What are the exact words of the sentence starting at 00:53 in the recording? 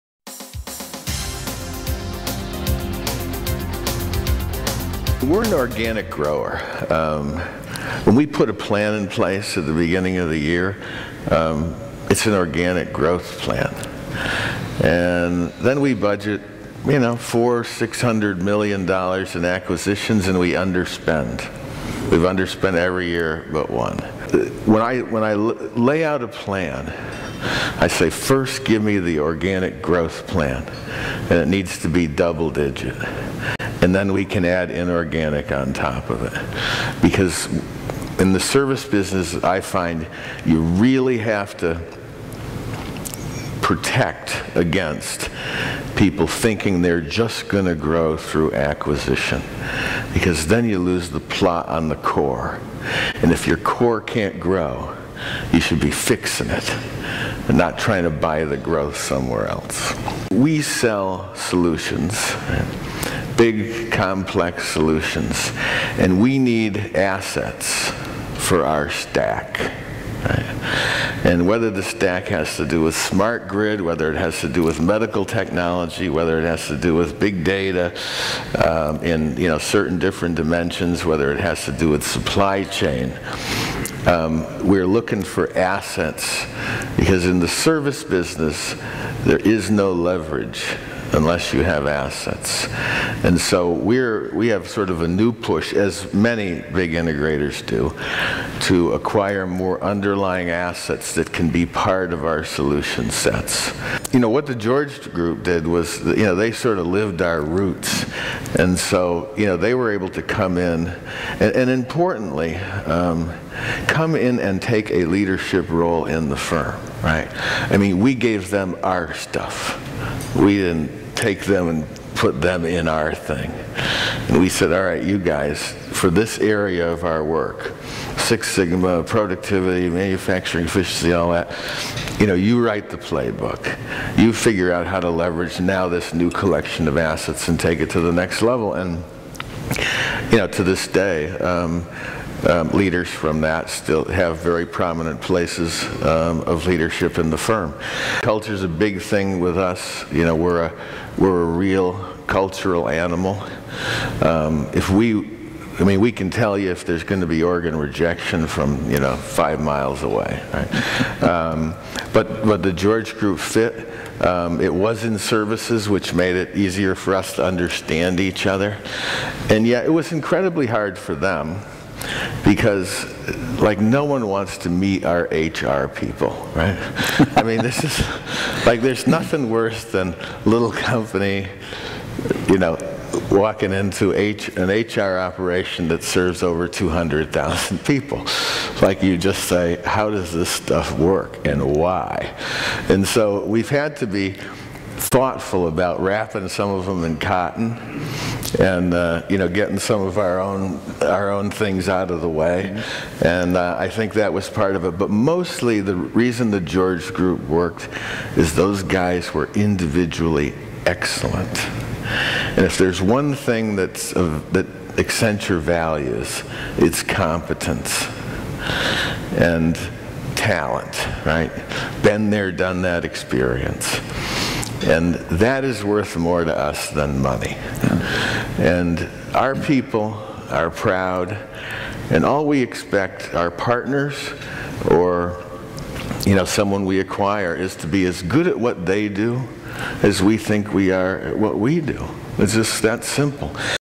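And if your core can't grow, you should be fixing it and not trying to buy the growth somewhere else.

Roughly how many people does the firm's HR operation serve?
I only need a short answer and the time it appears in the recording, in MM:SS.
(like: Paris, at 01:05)
200,000, at 03:06.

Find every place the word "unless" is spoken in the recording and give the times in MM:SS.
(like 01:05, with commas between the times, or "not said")
01:31.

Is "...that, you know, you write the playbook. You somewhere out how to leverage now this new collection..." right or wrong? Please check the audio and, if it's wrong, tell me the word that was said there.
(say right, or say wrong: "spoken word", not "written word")
wrong: "figure", not "somewhere".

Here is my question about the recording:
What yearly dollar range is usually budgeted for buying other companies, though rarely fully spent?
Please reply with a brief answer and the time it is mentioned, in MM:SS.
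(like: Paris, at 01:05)
$400-600 million, at 00:17.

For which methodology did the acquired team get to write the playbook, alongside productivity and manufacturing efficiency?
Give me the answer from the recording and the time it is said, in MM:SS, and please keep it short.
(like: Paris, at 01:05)
Six Sigma, at 02:08.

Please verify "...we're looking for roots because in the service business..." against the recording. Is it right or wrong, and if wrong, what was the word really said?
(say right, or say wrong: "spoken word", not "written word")
wrong: "assets", not "roots".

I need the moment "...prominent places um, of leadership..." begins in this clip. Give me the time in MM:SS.
02:24.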